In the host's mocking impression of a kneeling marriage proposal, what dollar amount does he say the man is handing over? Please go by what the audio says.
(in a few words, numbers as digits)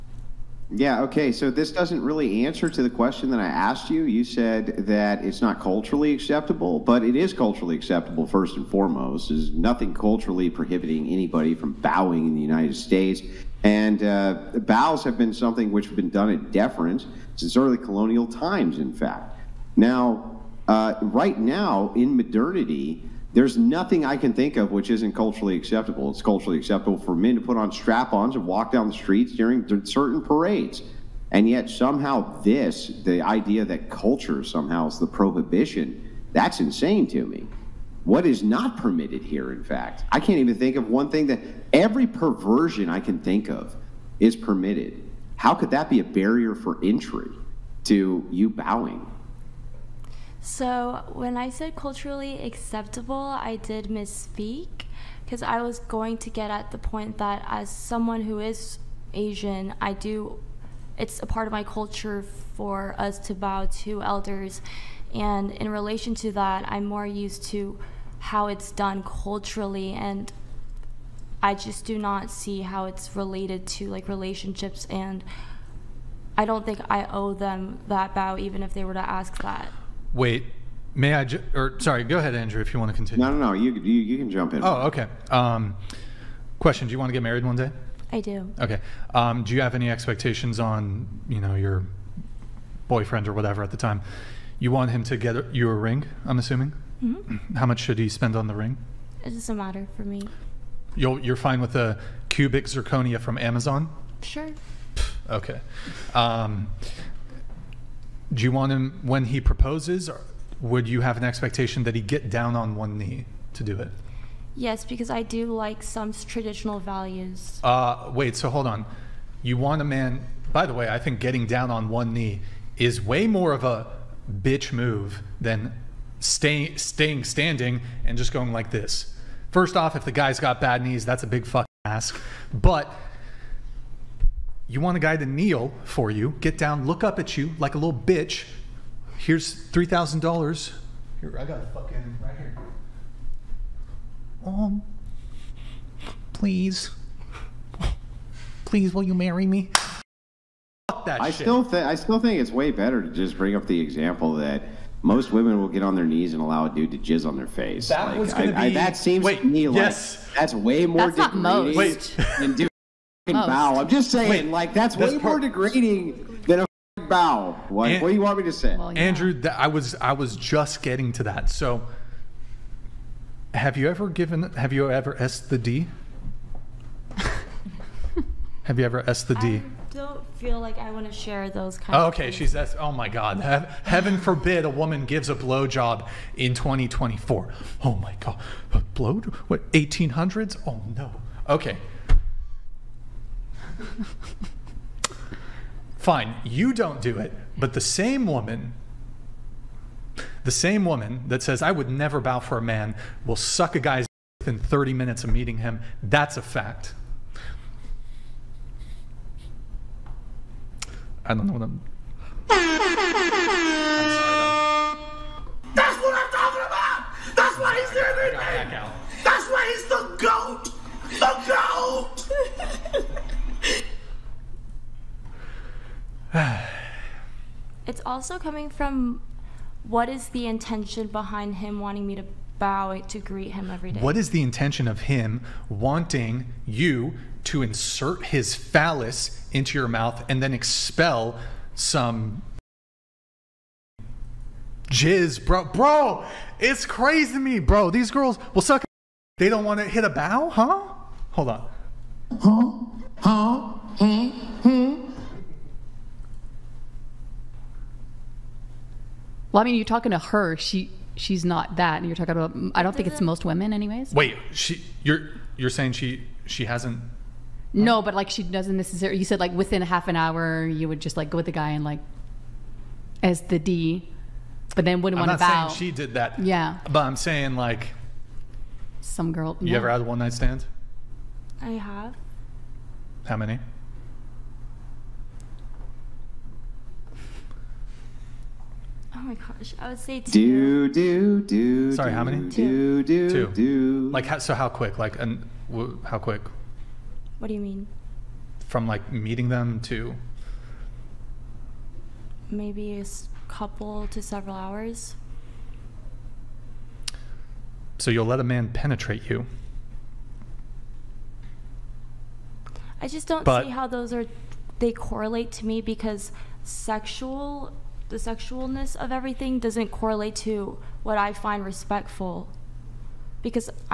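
$3,000.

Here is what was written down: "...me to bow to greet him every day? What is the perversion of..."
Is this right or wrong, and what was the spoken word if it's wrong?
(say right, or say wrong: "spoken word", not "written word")
wrong: "intention", not "perversion".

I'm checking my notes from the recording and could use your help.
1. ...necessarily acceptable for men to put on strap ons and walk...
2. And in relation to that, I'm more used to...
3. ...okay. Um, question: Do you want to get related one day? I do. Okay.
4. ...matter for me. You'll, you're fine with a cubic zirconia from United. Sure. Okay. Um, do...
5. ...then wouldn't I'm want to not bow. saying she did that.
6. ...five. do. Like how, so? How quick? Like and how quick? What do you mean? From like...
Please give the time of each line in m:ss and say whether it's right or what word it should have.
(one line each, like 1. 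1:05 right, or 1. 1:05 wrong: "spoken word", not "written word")
1. 0:26 wrong: "culturally", not "necessarily"
2. 1:05 right
3. 1:24 wrong: "married", not "related"
4. 1:39 wrong: "Amazon", not "United"
5. 4:34 right
6. 4:53 wrong: "two", not "five".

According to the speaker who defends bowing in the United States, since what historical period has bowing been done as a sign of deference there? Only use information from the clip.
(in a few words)
Early colonial times.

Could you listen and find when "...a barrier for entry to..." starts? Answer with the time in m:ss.
0:45.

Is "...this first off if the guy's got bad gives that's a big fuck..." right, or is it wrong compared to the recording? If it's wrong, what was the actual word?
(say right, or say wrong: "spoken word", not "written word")
wrong: "knees", not "gives".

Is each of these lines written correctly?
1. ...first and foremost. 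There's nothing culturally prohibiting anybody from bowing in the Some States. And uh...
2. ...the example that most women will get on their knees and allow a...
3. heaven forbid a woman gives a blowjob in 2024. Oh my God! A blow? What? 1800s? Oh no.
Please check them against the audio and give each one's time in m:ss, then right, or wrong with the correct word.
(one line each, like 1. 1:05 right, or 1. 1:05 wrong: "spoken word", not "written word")
1. 0:08 wrong: "United", not "Some"
2. 2:33 right
3. 3:03 right.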